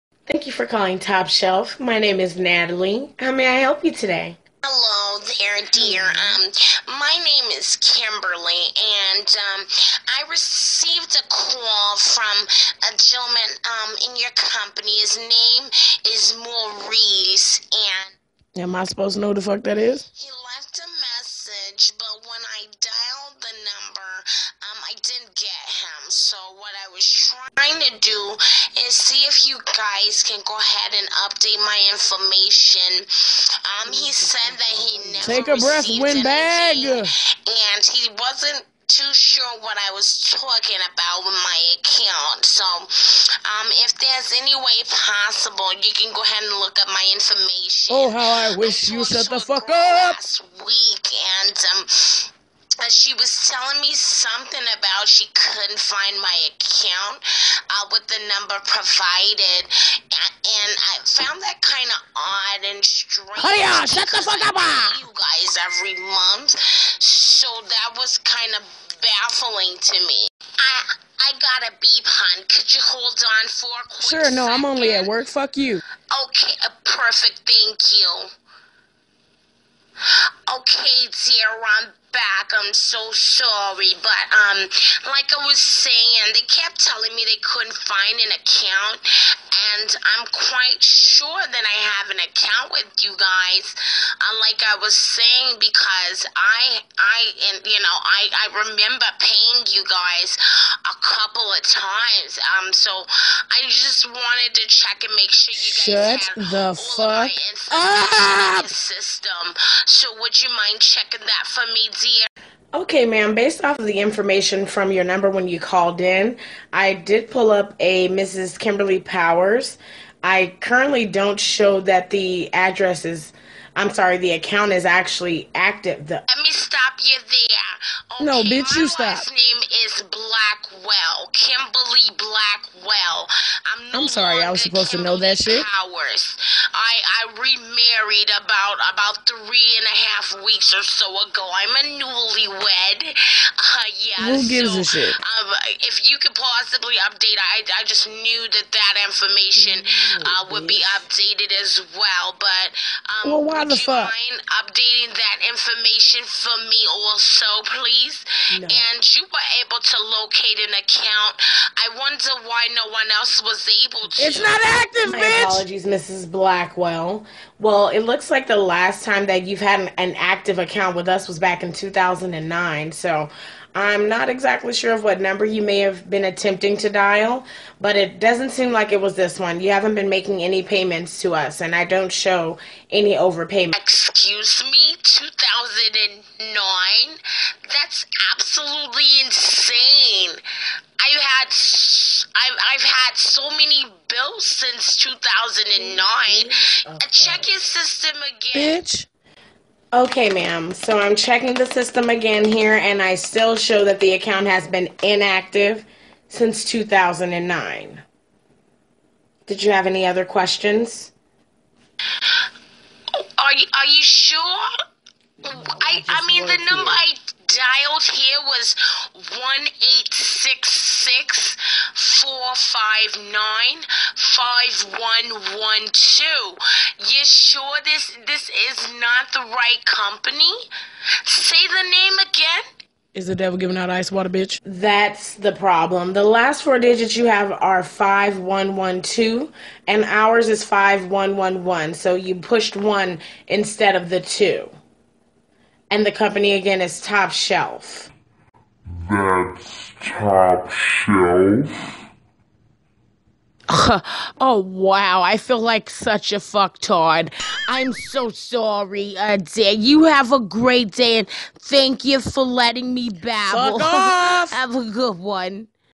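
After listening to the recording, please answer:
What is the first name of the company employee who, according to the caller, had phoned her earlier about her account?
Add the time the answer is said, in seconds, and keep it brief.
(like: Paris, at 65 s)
Maurice, at 16 s.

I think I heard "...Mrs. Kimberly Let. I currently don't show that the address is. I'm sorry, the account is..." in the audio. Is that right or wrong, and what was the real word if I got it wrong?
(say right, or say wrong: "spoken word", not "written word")
wrong: "Powers", not "Let".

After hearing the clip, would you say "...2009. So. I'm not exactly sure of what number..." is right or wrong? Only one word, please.
right.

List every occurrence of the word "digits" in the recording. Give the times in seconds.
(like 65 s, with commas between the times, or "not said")
236 s.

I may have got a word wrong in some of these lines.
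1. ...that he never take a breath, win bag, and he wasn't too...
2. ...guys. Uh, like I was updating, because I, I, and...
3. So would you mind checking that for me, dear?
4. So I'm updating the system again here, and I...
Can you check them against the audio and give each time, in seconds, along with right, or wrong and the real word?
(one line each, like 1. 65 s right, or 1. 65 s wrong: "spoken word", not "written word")
1. 34 s right
2. 93 s wrong: "saying", not "updating"
3. 109 s right
4. 200 s wrong: "checking", not "updating".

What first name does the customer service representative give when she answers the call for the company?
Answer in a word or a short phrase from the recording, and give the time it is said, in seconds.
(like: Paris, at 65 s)
Natalie, at 2 s.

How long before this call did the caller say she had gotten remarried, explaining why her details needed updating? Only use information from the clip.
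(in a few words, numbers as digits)
3 and a half weeks.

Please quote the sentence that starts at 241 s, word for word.
So you pushed one instead of the two and the company again is Top Shelf.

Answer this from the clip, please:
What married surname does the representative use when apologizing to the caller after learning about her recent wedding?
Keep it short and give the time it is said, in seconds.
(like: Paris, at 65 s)
Blackwell, at 166 s.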